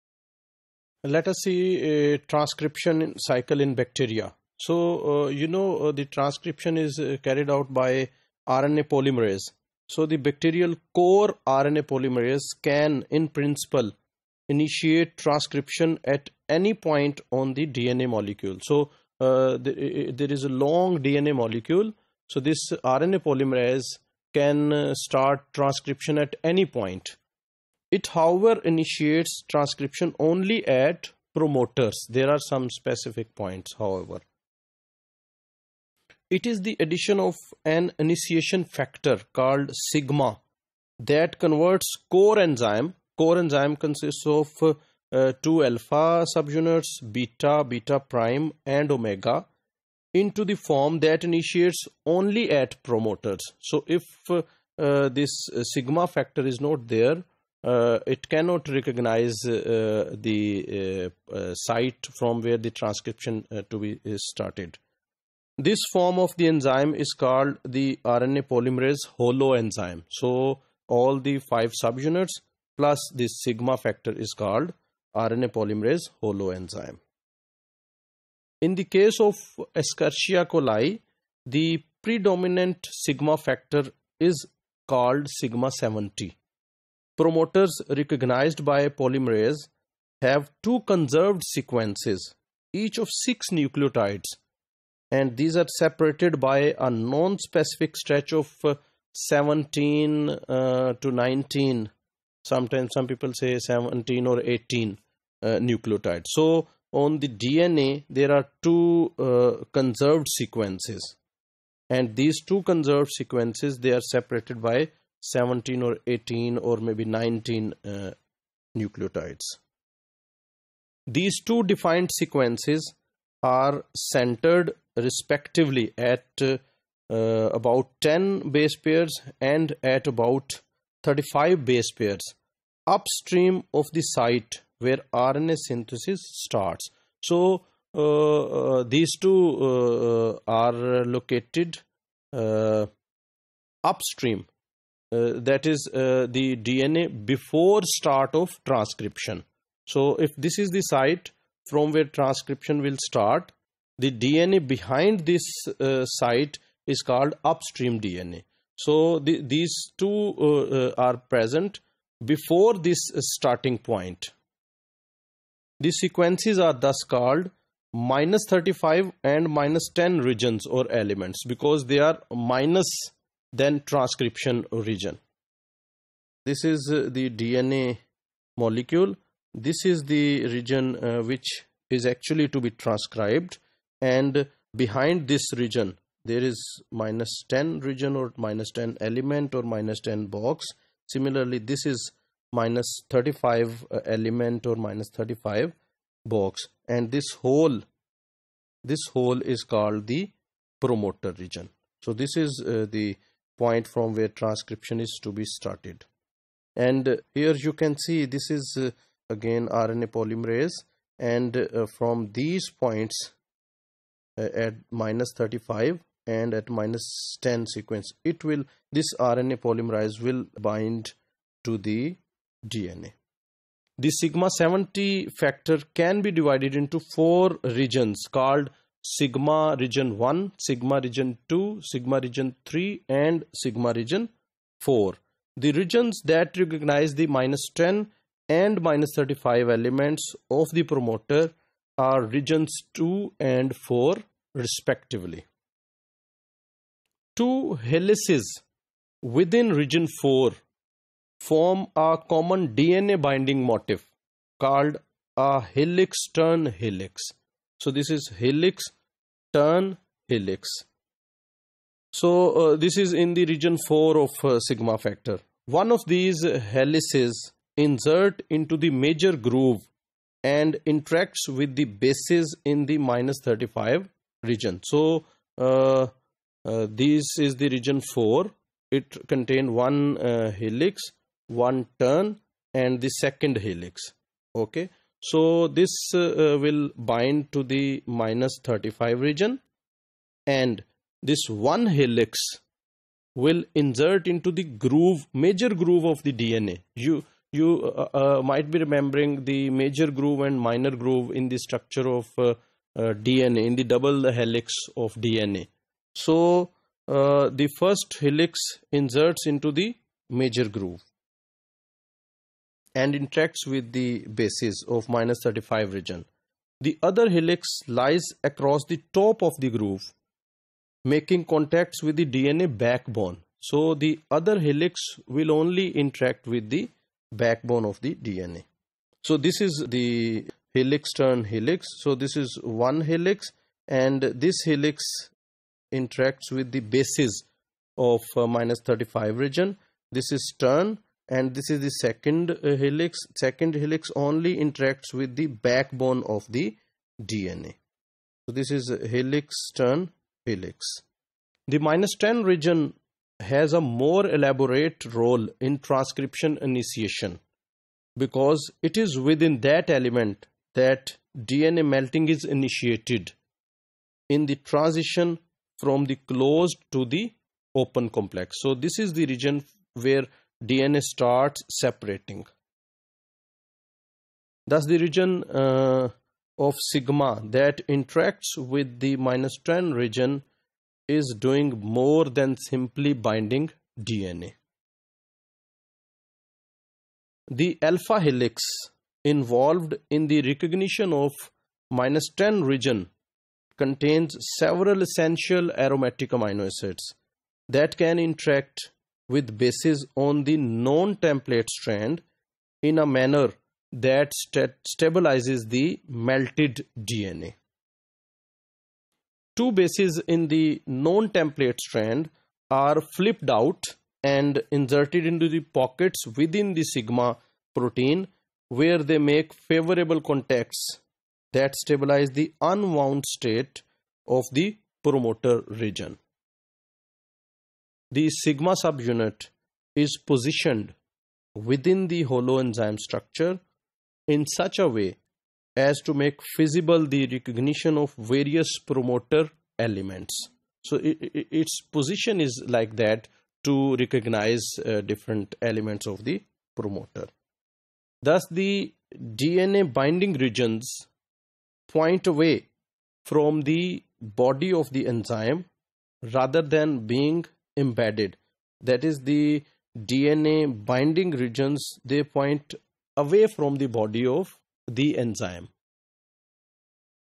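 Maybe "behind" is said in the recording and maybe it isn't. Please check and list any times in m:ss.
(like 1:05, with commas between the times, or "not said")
2:34, 3:04.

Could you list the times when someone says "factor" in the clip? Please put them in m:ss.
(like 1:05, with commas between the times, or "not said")
0:38, 0:56, 1:13, 1:23, 3:45, 4:25.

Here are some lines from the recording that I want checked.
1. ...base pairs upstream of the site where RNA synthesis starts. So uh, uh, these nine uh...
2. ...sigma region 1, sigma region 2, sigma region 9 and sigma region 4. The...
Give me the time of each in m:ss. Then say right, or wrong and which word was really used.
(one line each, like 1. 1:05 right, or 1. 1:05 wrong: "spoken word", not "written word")
1. 2:11 wrong: "two", not "nine"
2. 3:49 wrong: "3", not "9".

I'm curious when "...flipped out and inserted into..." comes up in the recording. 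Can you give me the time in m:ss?
6:53.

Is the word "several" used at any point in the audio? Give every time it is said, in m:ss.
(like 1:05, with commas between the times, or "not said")
6:34.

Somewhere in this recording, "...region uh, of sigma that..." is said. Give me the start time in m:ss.
6:14.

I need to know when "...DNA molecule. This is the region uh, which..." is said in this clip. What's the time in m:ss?
2:57.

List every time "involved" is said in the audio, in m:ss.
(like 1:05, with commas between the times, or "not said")
6:29.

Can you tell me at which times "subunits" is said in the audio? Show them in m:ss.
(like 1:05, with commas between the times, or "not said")
0:46, 1:11, 7:08.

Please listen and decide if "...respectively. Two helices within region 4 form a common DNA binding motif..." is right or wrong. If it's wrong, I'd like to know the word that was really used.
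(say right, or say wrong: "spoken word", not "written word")
right.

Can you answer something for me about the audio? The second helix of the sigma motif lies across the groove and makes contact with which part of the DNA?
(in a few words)
the DNA backbone.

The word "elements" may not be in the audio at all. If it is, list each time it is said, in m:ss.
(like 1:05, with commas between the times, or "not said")
2:50, 3:09, 3:14, 3:59, 5:59, 7:19, 7:25.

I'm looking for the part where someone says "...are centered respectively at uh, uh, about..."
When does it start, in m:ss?
2:03.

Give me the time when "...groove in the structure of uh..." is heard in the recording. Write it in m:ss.
5:00.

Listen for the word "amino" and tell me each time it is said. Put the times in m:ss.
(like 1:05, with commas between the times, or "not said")
6:36.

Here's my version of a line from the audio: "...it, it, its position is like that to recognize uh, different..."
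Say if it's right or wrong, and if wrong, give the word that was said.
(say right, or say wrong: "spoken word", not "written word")
right.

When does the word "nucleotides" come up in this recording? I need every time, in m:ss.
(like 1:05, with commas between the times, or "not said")
1:33, 1:45, 1:58.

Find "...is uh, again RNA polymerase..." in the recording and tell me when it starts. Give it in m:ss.
3:28.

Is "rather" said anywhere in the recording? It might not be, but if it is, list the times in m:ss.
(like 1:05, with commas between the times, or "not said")
7:36.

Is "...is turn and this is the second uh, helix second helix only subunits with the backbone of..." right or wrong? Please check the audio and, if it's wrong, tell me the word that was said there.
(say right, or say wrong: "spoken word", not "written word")
wrong: "interacts", not "subunits".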